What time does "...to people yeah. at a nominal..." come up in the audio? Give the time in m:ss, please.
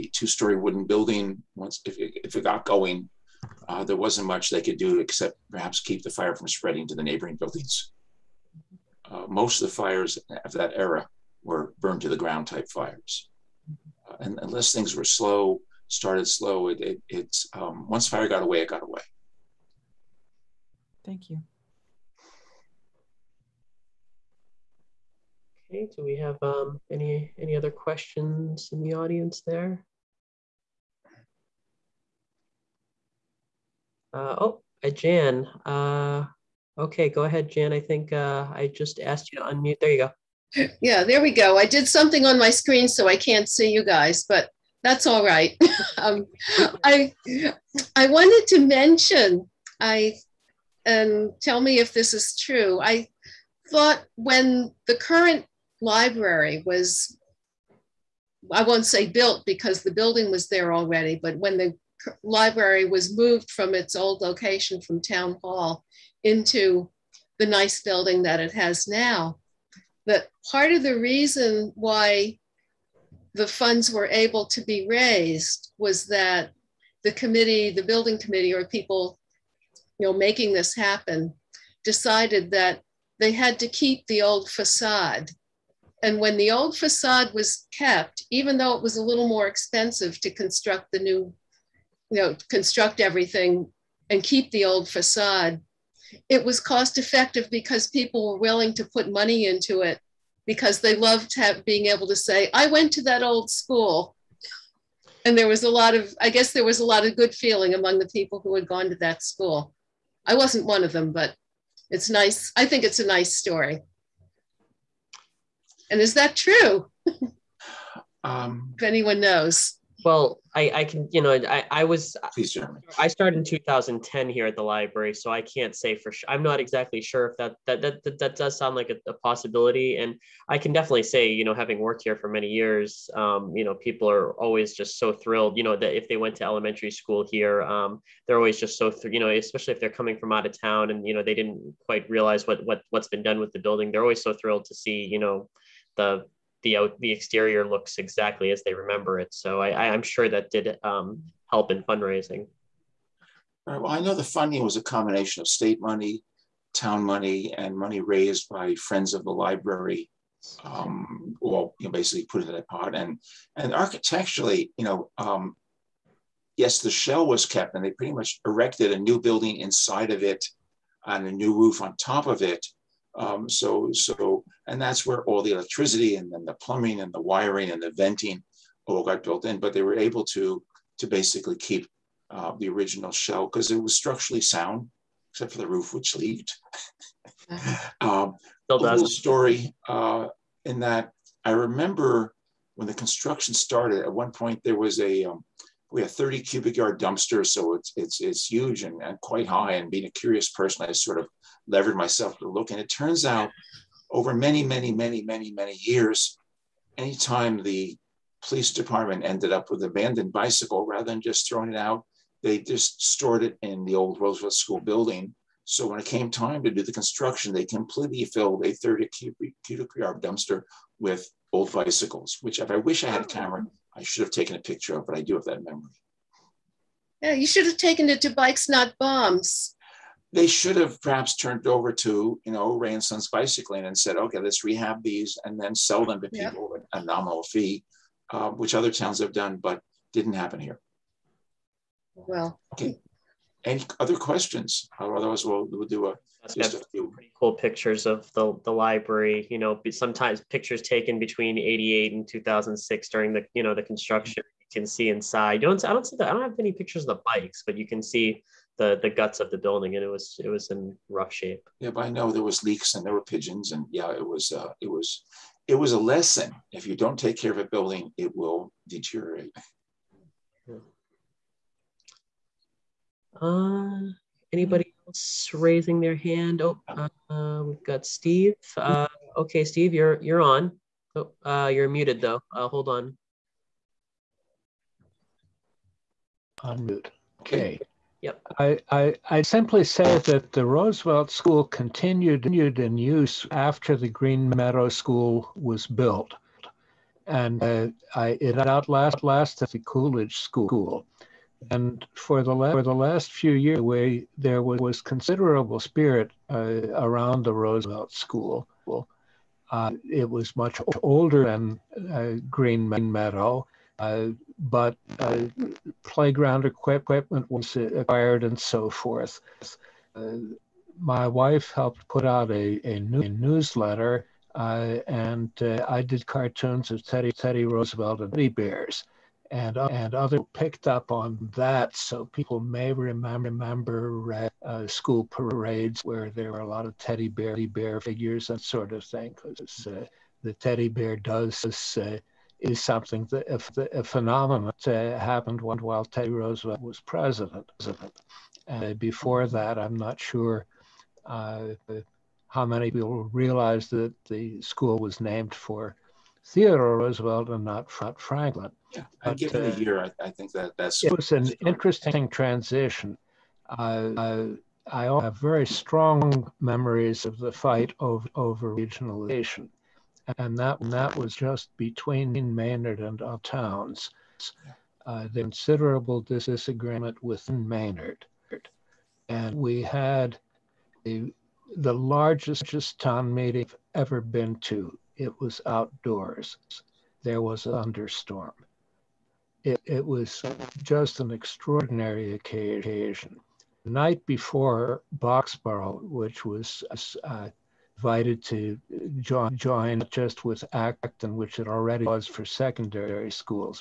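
3:56.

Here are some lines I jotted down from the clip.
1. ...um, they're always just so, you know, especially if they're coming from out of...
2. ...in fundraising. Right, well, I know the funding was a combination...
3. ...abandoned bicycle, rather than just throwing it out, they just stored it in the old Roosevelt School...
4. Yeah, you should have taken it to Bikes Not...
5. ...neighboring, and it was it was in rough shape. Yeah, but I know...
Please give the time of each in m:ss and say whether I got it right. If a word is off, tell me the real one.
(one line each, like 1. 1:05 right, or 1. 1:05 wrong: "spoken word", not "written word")
1. 2:17 right
2. 2:31 right
3. 3:29 right
4. 3:47 right
5. 4:19 wrong: "building", not "neighboring".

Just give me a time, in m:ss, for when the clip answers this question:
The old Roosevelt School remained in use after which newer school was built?
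4:54.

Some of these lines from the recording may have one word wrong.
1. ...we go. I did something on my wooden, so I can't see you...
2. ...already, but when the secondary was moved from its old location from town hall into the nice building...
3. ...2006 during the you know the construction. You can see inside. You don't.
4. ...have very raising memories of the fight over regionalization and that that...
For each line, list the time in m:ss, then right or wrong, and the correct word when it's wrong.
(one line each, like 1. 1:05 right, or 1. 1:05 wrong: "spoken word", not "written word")
1. 0:41 wrong: "screen", not "wooden"
2. 1:00 wrong: "library", not "secondary"
3. 4:12 right
4. 6:05 wrong: "strong", not "raising".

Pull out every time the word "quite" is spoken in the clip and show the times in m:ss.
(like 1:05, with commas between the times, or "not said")
2:21, 3:19.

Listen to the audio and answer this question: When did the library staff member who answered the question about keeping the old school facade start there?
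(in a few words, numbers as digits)
2010.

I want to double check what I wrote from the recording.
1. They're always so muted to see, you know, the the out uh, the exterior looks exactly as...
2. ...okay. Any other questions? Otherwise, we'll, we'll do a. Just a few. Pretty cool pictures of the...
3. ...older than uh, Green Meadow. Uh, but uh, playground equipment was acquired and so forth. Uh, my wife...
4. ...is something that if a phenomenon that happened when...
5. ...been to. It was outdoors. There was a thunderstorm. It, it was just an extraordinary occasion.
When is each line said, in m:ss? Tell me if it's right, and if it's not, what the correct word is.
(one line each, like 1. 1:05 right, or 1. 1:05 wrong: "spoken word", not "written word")
1. 2:23 wrong: "thrilled", not "muted"
2. 4:02 right
3. 5:11 right
4. 5:42 right
5. 6:24 right.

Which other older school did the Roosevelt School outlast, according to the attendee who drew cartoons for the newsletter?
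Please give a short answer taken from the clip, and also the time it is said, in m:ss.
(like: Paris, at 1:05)
Coolidge School, at 4:59.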